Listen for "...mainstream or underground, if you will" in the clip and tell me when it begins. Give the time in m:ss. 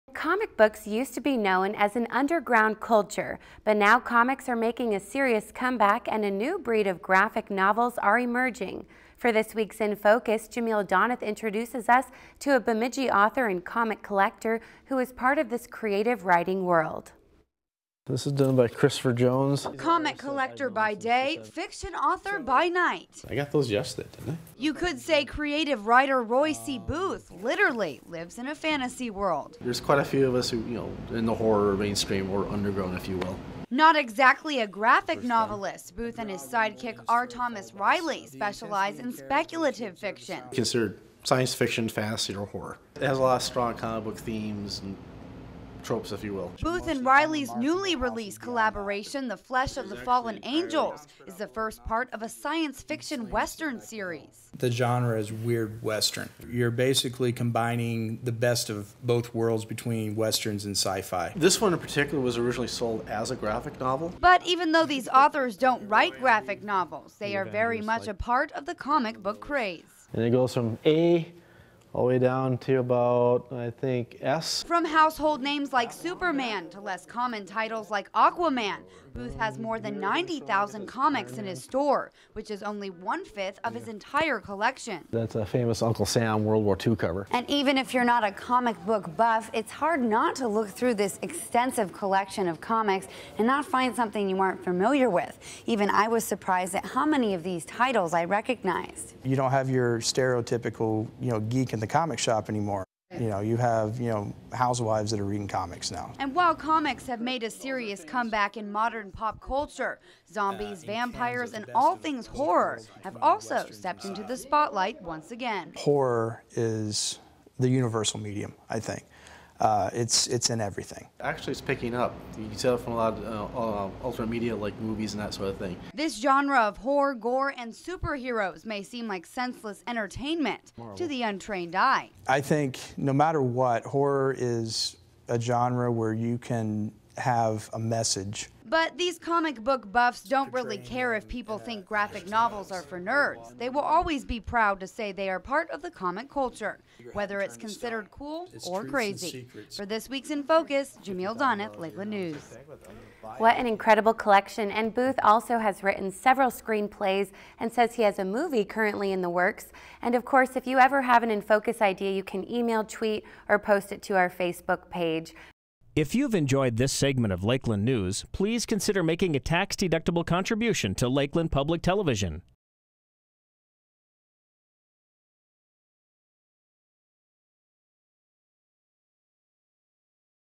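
0:31.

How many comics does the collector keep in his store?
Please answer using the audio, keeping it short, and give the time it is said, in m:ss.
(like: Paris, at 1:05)
90,000, at 1:19.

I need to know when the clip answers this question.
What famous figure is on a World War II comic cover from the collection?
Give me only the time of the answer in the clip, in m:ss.
1:25.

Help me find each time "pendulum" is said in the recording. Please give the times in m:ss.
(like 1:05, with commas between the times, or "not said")
not said.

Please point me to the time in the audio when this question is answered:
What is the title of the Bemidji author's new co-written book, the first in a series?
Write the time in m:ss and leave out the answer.
0:49.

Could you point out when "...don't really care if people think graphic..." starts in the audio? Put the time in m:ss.
2:20.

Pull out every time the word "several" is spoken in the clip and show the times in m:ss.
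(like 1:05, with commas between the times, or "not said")
2:36.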